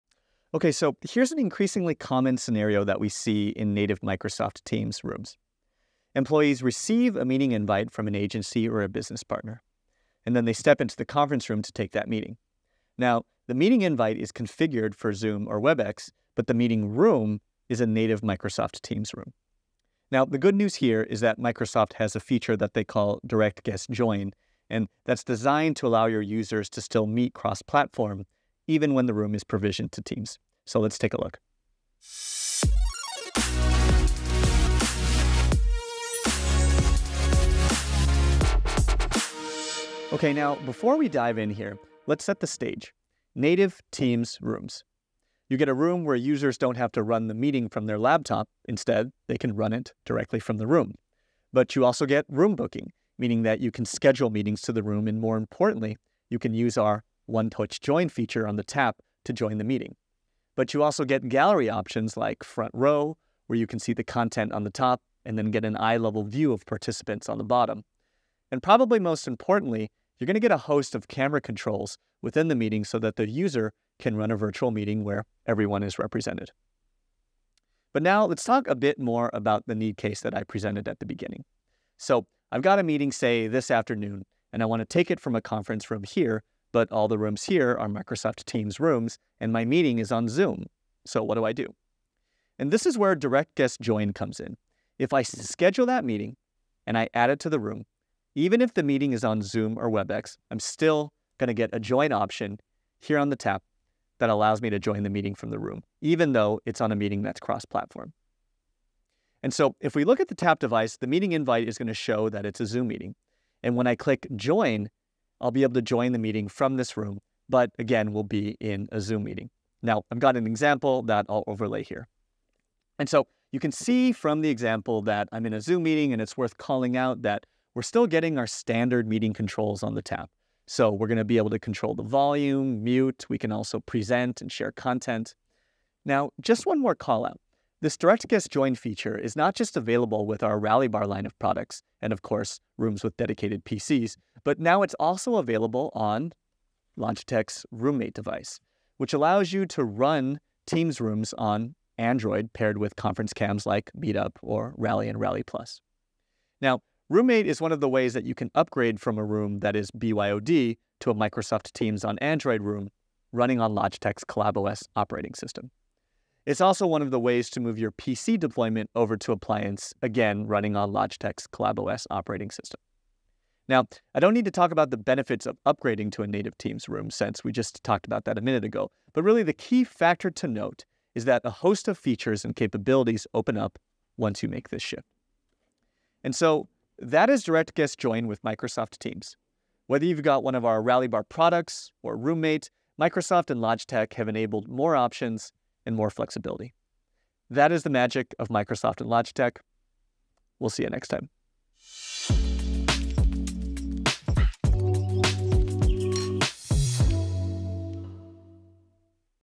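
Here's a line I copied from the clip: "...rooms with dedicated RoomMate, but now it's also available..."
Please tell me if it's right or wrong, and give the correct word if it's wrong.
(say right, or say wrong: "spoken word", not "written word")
wrong: "PCs", not "RoomMate".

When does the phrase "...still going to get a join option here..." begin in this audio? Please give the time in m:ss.
1:40.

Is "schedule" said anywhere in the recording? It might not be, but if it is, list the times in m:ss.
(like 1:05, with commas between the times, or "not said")
0:53, 1:35.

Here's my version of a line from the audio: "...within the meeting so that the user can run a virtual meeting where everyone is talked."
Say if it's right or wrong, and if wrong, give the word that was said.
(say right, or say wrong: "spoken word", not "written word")
wrong: "represented", not "talked".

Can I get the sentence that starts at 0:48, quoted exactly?
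Instead, they can run it directly from the room.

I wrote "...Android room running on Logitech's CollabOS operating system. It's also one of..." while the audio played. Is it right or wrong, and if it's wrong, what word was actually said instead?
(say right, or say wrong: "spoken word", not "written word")
right.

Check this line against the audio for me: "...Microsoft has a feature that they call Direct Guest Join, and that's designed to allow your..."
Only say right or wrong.
right.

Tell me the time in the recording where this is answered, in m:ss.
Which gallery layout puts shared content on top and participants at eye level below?
1:02.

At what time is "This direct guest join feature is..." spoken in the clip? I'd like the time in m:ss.
2:17.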